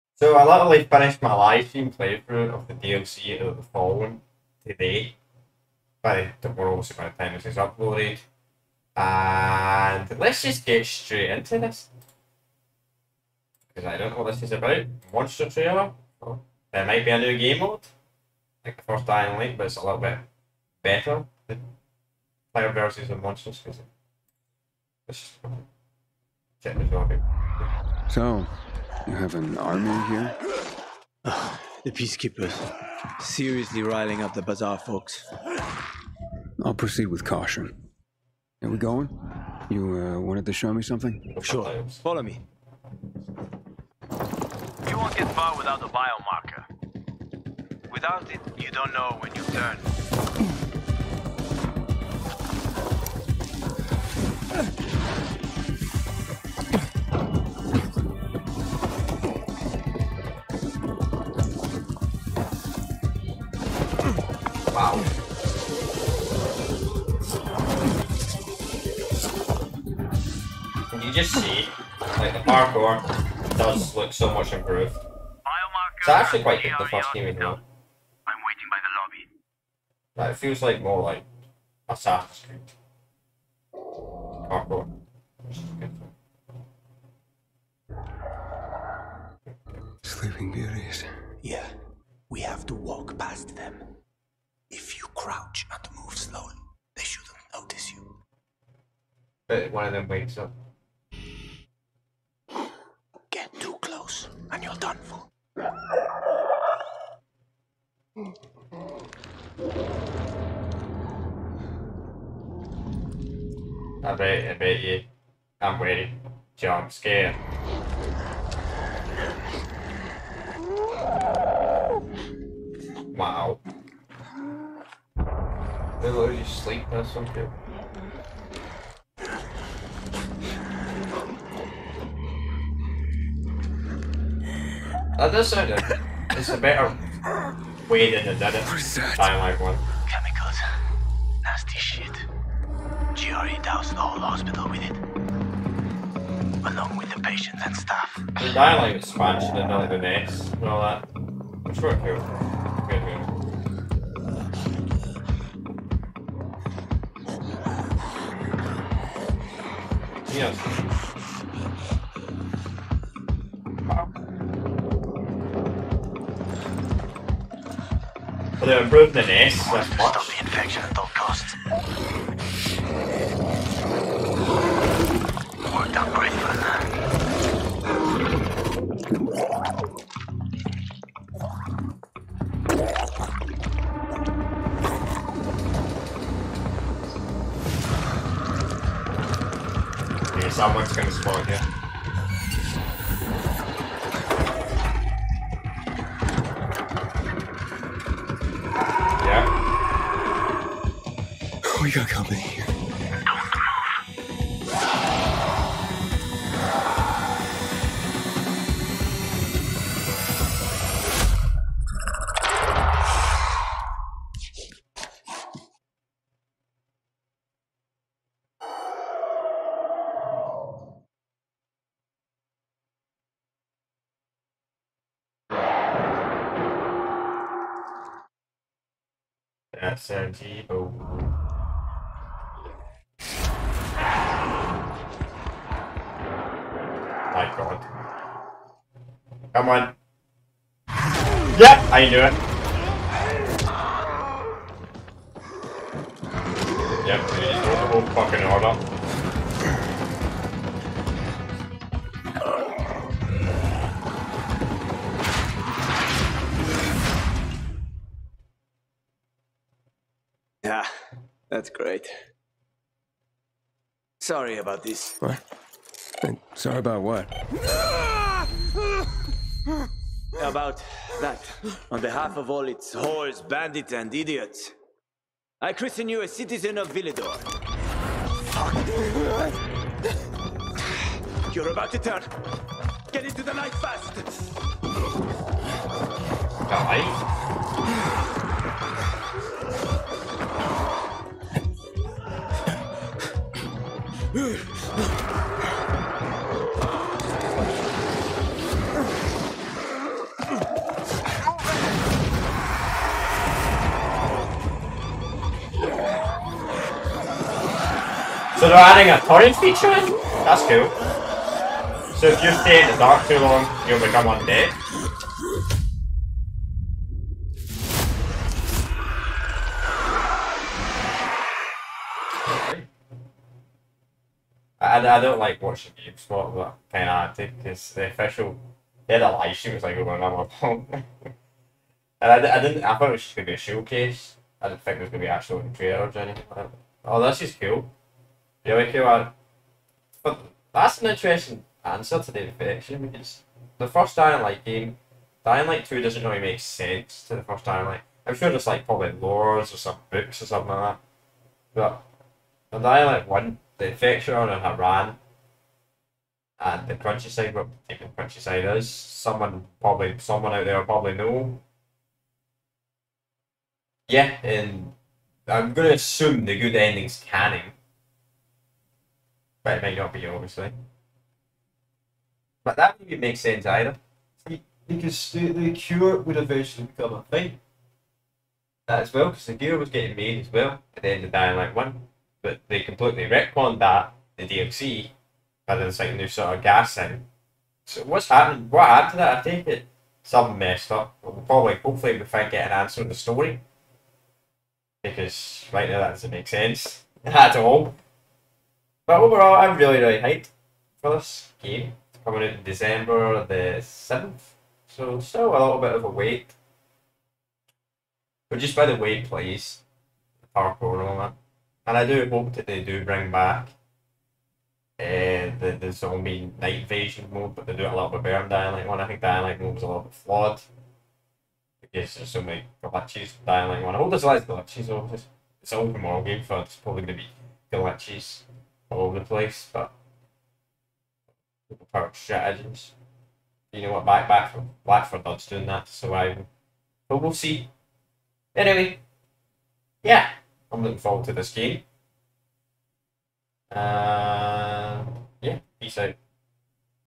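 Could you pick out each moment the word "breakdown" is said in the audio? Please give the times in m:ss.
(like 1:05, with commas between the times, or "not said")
not said.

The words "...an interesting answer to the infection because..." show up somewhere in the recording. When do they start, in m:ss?
5:41.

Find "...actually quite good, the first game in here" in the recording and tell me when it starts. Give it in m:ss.
1:16.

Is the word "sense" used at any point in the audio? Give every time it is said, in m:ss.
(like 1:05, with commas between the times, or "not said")
5:46, 6:13, 6:36.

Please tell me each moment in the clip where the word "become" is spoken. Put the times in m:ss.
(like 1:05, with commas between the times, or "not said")
5:13, 6:16.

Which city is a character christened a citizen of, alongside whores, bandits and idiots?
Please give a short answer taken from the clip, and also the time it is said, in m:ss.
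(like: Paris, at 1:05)
Villedor, at 4:36.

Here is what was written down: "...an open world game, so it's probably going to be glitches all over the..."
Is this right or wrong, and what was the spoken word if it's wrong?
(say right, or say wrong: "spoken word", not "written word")
right.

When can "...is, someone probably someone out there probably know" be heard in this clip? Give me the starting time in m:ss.
5:58.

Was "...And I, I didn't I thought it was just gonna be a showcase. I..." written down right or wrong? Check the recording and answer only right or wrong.
right.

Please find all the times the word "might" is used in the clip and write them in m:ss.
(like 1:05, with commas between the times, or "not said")
0:16, 6:09.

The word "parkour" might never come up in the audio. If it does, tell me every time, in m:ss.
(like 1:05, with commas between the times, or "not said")
1:12, 1:23, 6:50.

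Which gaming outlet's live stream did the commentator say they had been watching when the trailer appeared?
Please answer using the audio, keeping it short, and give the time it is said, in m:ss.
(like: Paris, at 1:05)
GameSpot, at 5:25.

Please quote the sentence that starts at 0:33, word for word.
Seriously riling up the bazaar, folks.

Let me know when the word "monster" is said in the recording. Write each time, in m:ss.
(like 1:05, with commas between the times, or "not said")
0:15, 0:23.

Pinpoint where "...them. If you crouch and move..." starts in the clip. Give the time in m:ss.
1:33.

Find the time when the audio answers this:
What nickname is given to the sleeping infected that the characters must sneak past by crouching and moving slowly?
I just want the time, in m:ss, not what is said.
1:30.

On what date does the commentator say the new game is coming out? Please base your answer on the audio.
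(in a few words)
December 7.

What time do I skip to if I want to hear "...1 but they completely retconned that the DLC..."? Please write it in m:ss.
6:21.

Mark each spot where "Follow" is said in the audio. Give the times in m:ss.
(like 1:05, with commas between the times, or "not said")
0:42.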